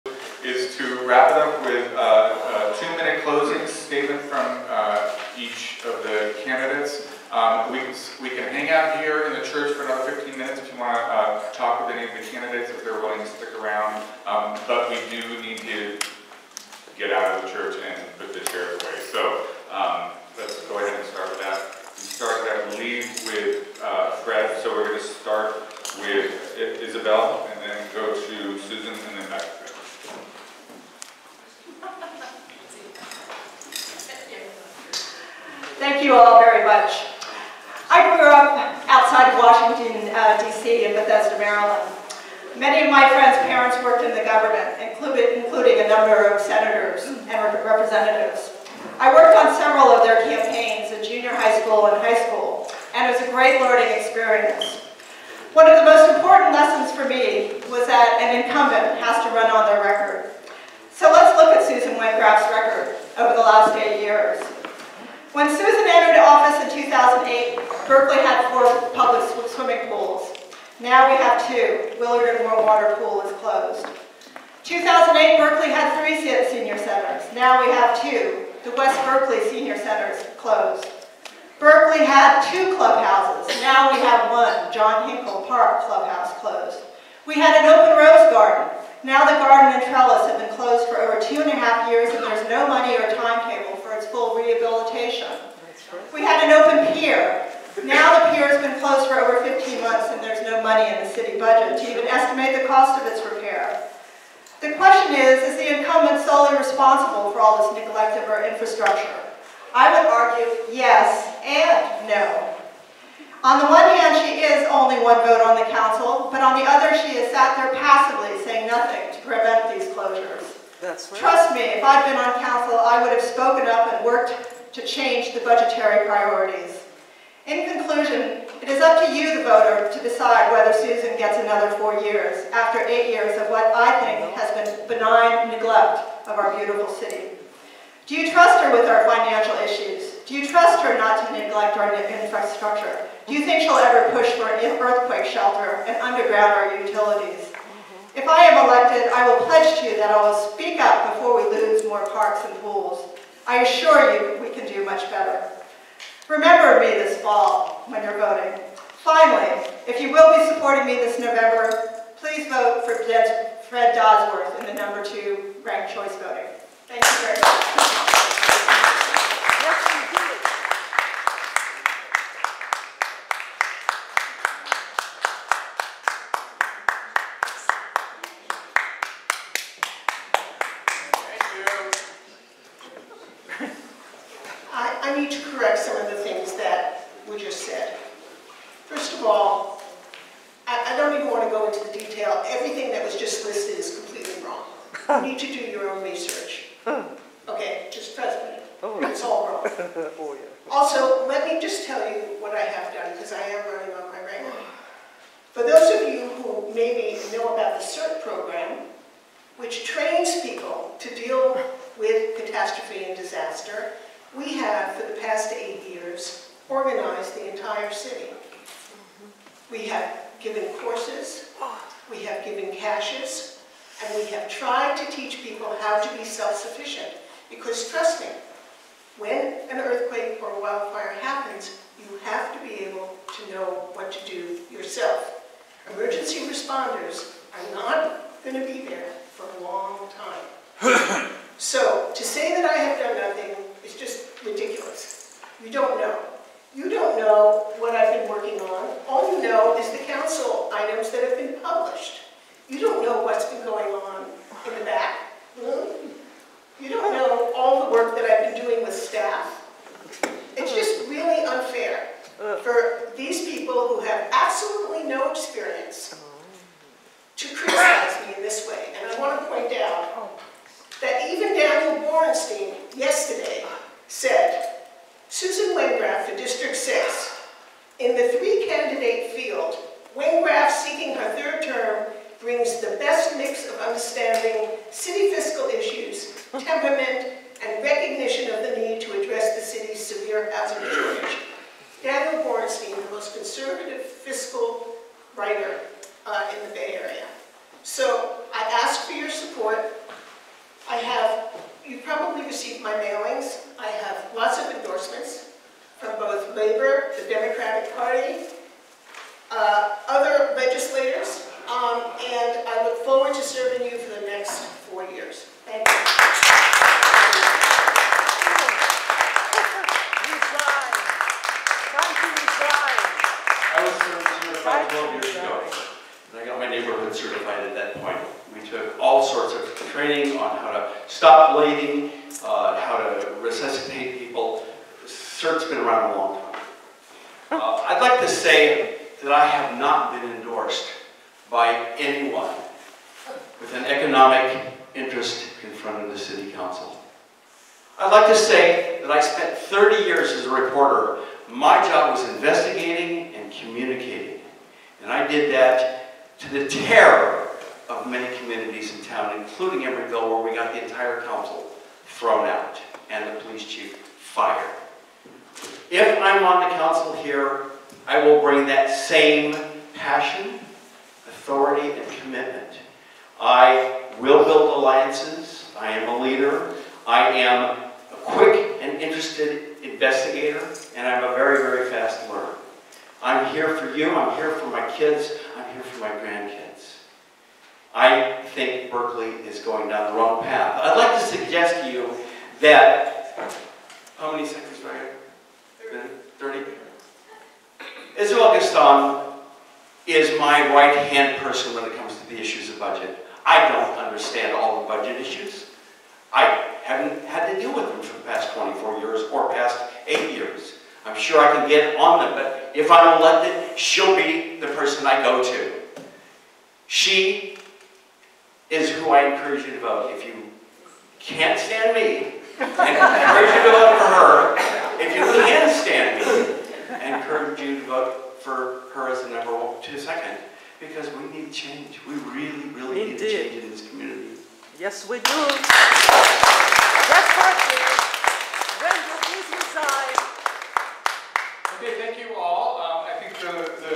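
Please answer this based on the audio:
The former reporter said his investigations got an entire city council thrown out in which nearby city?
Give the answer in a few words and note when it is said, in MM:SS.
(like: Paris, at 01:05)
Emeryville, at 05:59.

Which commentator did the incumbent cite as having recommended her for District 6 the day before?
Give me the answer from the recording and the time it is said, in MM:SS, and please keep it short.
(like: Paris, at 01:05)
Daniel Borenstein, at 04:31.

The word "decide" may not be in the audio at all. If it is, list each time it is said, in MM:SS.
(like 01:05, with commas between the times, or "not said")
02:10.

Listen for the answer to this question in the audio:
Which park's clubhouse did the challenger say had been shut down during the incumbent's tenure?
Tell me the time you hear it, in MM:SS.
01:24.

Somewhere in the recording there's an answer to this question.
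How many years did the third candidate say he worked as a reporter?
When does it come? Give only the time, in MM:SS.
05:49.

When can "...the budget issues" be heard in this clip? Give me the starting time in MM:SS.
06:44.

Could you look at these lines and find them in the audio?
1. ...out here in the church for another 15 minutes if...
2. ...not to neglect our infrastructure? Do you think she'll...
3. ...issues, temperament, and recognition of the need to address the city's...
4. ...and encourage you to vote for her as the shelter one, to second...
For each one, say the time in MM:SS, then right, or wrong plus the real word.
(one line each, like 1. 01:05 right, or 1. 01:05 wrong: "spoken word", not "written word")
1. 00:08 right
2. 02:20 right
3. 04:45 right
4. 07:07 wrong: "number", not "shelter".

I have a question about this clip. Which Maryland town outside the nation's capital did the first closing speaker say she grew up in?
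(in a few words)
Bethesda.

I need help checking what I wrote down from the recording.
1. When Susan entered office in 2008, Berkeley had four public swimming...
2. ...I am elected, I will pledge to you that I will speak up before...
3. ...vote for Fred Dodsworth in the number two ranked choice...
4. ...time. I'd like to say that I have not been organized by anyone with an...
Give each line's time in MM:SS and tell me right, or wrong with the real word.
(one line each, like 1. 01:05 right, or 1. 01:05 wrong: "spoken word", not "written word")
1. 01:05 right
2. 02:28 right
3. 02:42 right
4. 05:36 wrong: "endorsed", not "organized".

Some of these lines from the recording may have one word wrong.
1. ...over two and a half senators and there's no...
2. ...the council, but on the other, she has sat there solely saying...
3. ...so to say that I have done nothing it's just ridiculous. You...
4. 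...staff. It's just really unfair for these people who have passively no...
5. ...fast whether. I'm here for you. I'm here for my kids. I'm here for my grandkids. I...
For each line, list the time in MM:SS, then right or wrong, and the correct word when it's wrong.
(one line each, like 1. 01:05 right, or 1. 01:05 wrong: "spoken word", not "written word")
1. 01:31 wrong: "years", not "senators"
2. 01:55 wrong: "passively", not "solely"
3. 04:01 right
4. 04:18 wrong: "absolutely", not "passively"
5. 06:21 wrong: "learner", not "whether".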